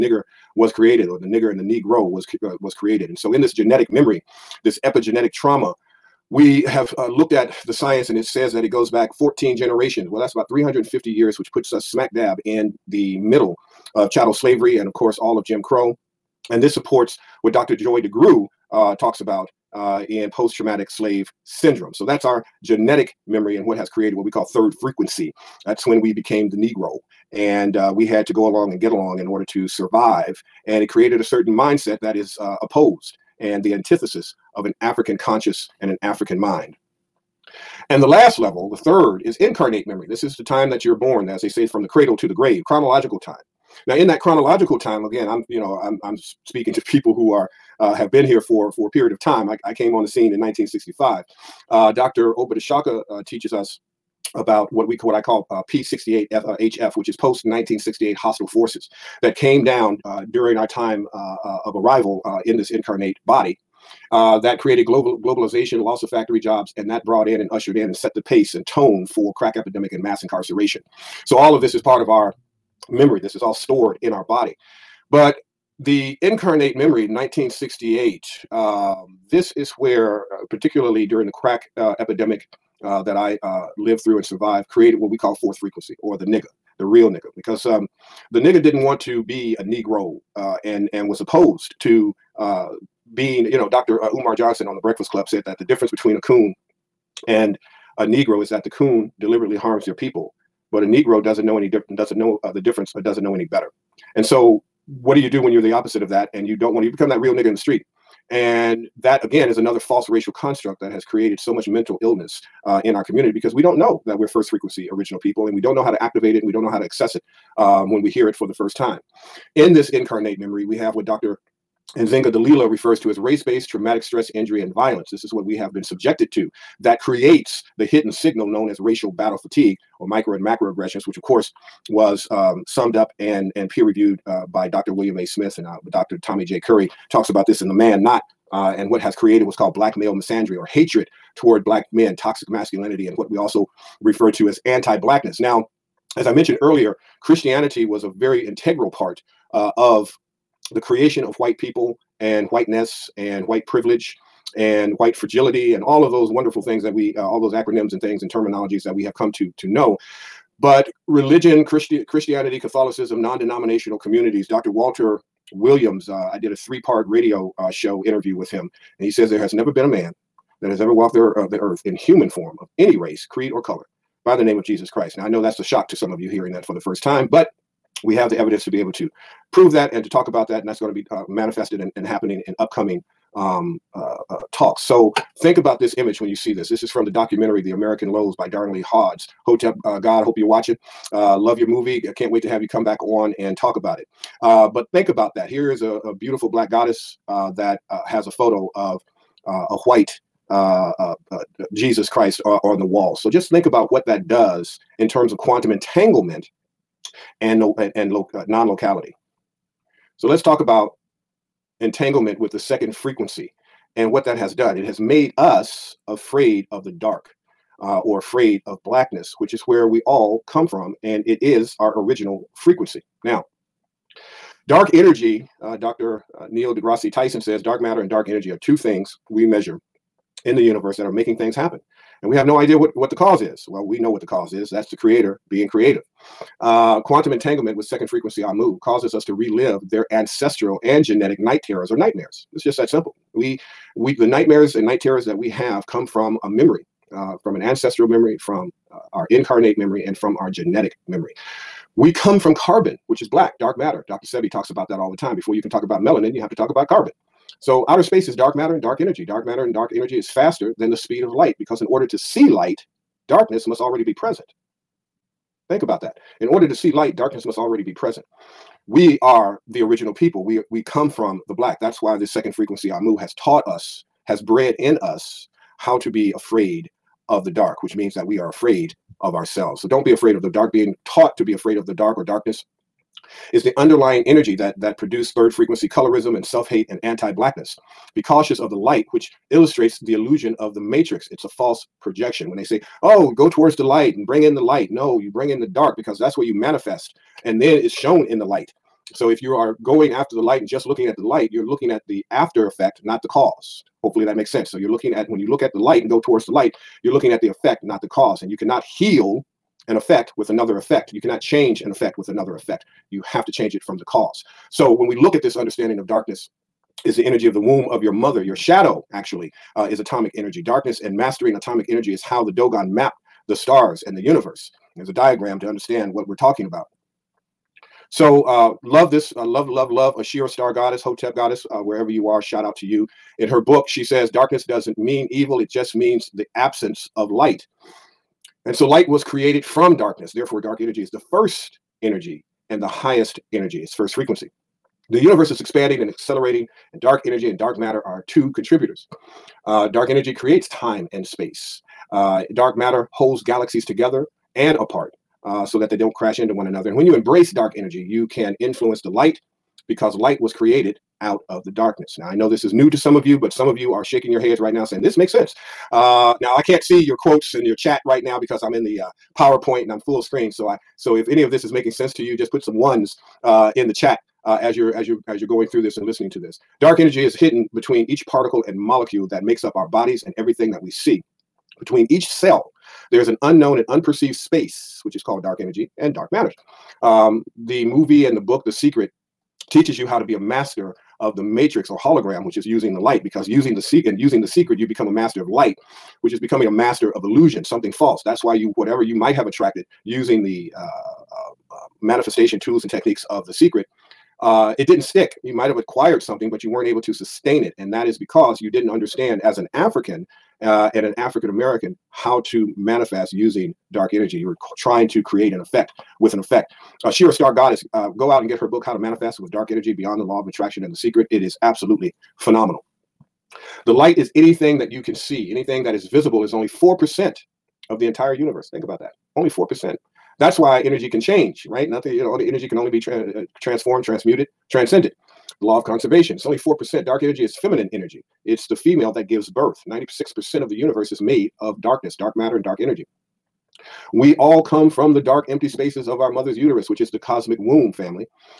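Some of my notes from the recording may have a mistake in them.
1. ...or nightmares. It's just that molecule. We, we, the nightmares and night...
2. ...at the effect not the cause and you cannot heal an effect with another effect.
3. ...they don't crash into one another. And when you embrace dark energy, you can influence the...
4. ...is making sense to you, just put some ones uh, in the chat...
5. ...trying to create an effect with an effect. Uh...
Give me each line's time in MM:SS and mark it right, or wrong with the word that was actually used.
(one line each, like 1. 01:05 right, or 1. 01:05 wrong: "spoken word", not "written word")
1. 04:01 wrong: "simple", not "molecule"
2. 05:07 right
3. 05:55 right
4. 06:11 right
5. 06:54 right.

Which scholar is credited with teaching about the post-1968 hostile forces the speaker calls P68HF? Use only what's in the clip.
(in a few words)
Dr. Oba T'Shaka.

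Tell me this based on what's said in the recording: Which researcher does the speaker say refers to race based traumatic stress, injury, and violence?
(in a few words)
Dr. Nzinga Dalila.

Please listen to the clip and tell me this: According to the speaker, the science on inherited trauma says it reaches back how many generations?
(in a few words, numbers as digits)
14.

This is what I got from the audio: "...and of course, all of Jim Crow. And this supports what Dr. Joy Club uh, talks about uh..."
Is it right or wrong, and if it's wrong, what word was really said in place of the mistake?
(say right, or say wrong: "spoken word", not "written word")
wrong: "DeGruy", not "Club".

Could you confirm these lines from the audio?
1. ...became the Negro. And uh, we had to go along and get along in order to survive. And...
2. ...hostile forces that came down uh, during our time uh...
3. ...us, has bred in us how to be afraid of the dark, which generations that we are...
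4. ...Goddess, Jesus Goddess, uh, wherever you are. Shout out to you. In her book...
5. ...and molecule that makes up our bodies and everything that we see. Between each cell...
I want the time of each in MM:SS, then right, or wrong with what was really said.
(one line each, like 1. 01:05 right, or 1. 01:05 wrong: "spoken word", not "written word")
1. 00:26 right
2. 00:58 right
3. 04:33 wrong: "means", not "generations"
4. 05:30 wrong: "Hotep", not "Jesus"
5. 06:18 right.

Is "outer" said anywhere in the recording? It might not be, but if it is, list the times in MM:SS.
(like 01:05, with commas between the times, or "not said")
04:17.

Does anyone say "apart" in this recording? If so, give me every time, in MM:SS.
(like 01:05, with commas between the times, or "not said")
05:54.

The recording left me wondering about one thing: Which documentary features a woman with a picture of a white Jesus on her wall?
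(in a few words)
The American Lows.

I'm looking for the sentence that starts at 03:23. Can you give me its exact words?
So just think about what that does in terms of quantum entanglement and, and, and non-locality.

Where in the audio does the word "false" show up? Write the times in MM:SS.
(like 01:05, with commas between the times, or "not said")
01:49, 04:51, 06:37.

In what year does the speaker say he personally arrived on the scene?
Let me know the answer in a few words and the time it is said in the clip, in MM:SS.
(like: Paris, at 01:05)
1965, at 00:50.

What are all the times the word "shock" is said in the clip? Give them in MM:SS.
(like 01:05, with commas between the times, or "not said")
02:55.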